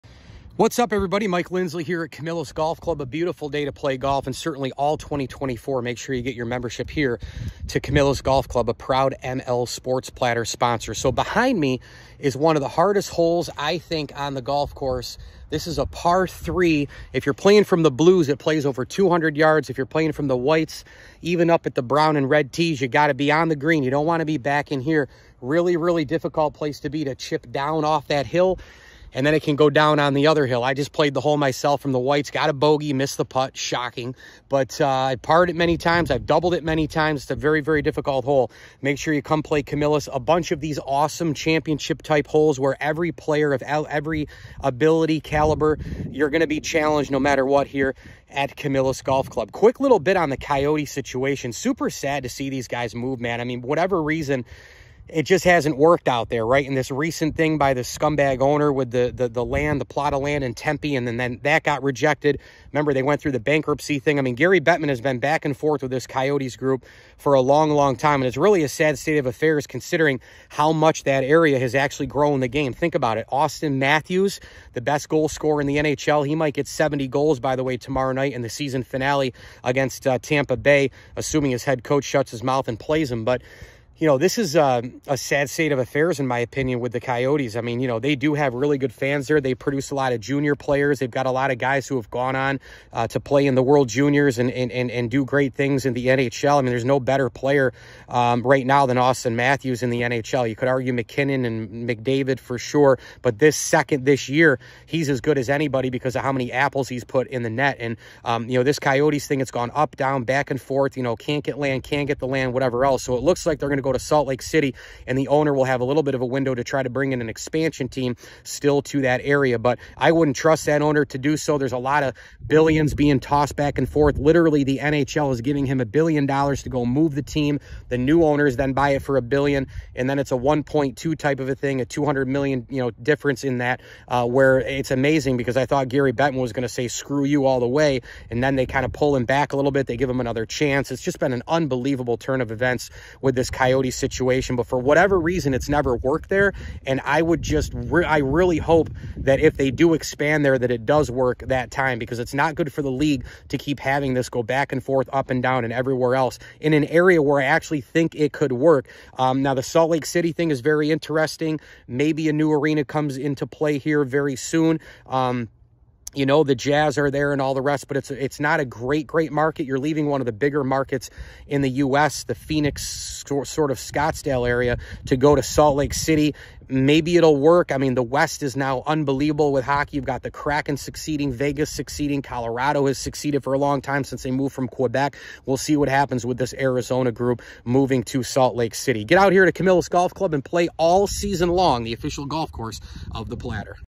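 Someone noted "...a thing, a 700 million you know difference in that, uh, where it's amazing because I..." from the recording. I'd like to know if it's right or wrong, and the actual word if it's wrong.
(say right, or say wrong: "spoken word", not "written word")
wrong: "200", not "700".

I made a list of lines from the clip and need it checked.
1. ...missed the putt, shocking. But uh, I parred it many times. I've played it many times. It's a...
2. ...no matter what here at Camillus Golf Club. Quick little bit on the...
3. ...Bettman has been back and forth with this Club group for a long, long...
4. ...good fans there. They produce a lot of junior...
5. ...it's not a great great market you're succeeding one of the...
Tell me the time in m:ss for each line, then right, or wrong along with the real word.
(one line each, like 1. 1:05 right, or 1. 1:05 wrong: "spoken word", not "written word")
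1. 0:32 wrong: "doubled", not "played"
2. 0:47 right
3. 1:04 wrong: "Coyotes", not "Club"
4. 1:28 right
5. 2:48 wrong: "leaving", not "succeeding".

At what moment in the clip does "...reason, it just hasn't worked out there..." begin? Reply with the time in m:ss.
0:54.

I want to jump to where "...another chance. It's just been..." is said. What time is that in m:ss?
2:20.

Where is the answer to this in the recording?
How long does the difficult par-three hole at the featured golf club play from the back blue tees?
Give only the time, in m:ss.
0:18.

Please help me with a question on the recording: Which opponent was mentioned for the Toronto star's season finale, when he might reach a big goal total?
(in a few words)
Tampa Bay.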